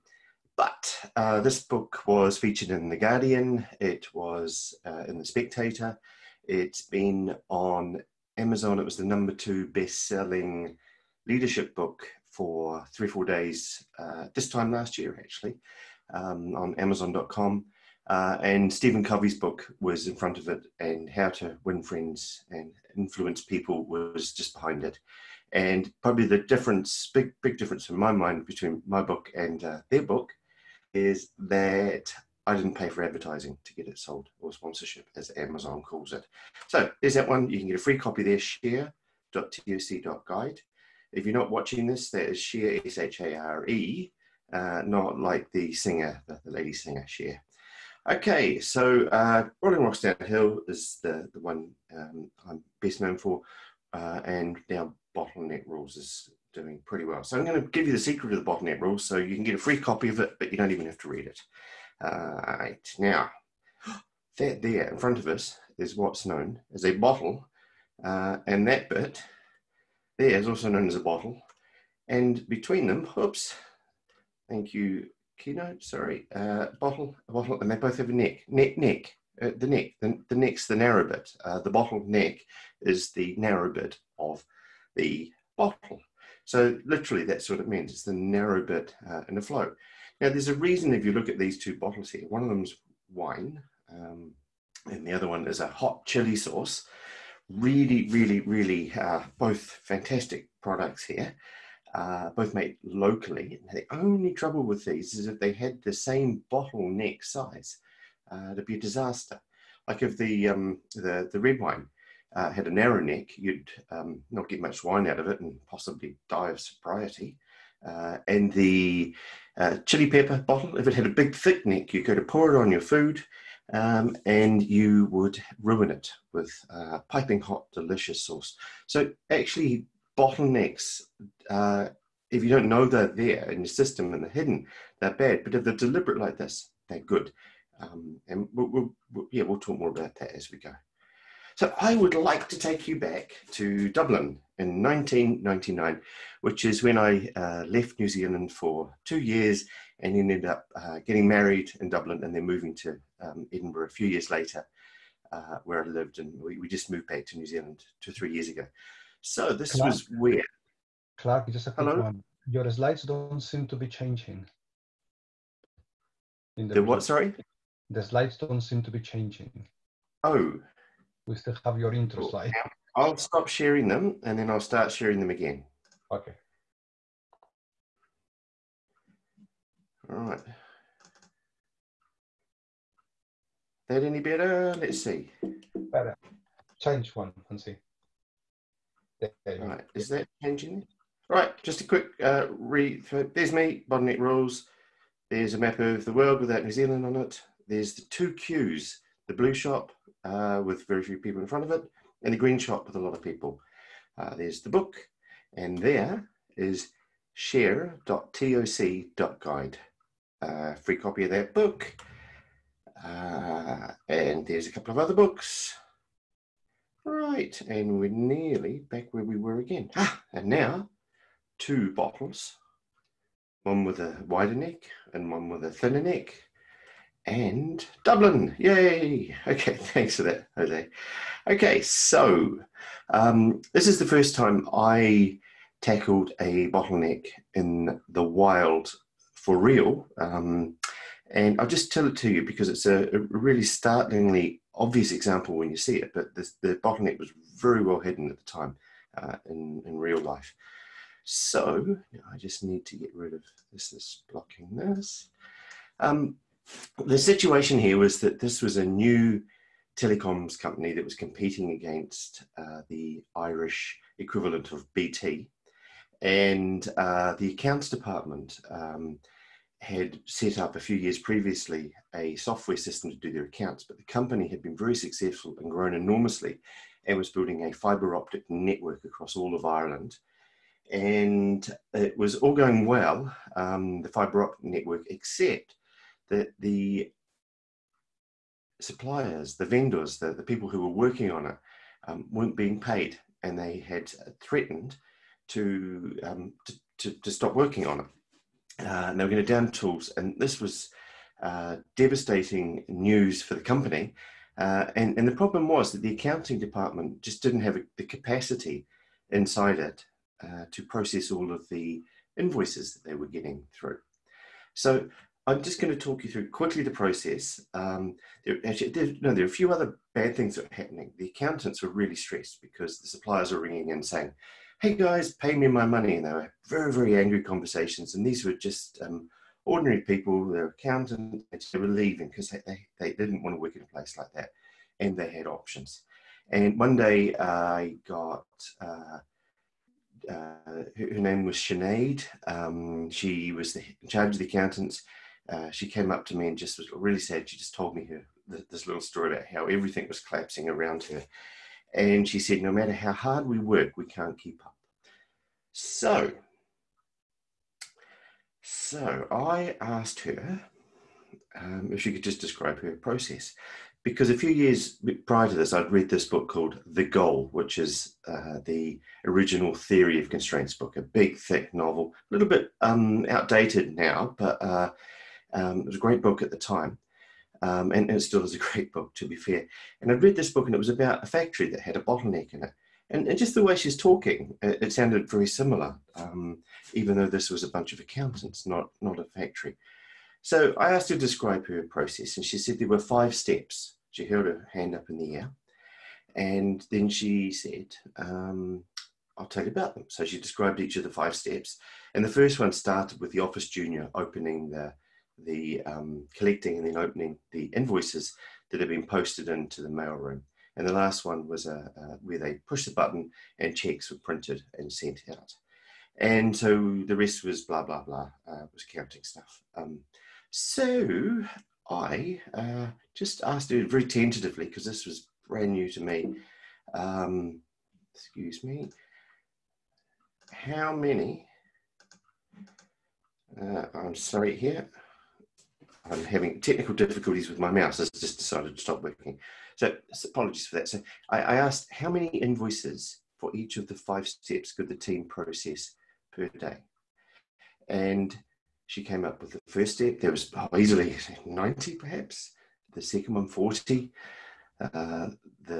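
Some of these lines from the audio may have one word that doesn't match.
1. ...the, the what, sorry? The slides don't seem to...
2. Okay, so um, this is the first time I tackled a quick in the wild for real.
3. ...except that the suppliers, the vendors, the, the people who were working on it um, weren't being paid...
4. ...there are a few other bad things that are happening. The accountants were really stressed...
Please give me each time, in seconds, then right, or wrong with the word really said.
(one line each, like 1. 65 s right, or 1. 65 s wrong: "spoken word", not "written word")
1. 166 s right
2. 231 s wrong: "bottleneck", not "quick"
3. 285 s right
4. 319 s right.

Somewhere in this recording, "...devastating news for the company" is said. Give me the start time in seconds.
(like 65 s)
301 s.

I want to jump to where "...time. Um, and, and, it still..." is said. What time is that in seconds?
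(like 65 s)
376 s.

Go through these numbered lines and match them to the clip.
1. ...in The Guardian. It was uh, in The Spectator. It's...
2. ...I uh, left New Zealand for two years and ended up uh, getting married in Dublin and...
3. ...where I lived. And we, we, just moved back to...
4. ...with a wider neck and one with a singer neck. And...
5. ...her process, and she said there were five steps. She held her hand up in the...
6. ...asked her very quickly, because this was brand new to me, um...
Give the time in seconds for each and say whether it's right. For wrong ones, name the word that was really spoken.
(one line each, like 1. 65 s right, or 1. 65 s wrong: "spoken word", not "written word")
1. 2 s right
2. 146 s right
3. 155 s right
4. 223 s wrong: "thinner", not "singer"
5. 391 s right
6. 423 s wrong: "tentatively", not "quickly".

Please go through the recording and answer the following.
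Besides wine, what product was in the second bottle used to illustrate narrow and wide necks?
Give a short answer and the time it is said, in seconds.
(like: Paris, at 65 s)
hot chili sauce, at 95 s.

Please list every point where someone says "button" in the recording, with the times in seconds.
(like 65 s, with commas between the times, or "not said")
412 s.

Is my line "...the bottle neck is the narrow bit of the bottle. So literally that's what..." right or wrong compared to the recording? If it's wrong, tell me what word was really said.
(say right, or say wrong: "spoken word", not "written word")
right.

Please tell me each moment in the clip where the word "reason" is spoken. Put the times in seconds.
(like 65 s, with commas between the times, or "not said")
90 s.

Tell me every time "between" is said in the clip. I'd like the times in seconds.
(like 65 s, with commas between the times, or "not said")
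28 s, 72 s.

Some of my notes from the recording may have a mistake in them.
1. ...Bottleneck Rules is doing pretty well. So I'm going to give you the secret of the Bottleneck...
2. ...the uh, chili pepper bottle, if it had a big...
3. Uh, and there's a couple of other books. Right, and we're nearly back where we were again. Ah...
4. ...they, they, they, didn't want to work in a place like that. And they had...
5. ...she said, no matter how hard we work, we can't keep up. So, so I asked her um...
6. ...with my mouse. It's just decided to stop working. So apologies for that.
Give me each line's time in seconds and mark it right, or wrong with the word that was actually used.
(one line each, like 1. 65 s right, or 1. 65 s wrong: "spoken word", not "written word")
1. 55 s right
2. 118 s right
3. 213 s right
4. 332 s right
5. 352 s right
6. 437 s right.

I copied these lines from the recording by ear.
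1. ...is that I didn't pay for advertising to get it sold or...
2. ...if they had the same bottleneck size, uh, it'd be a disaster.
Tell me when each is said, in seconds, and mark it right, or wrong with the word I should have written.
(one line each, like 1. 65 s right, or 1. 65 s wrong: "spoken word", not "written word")
1. 30 s right
2. 105 s right.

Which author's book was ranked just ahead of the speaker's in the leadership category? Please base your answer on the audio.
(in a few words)
Stephen Covey.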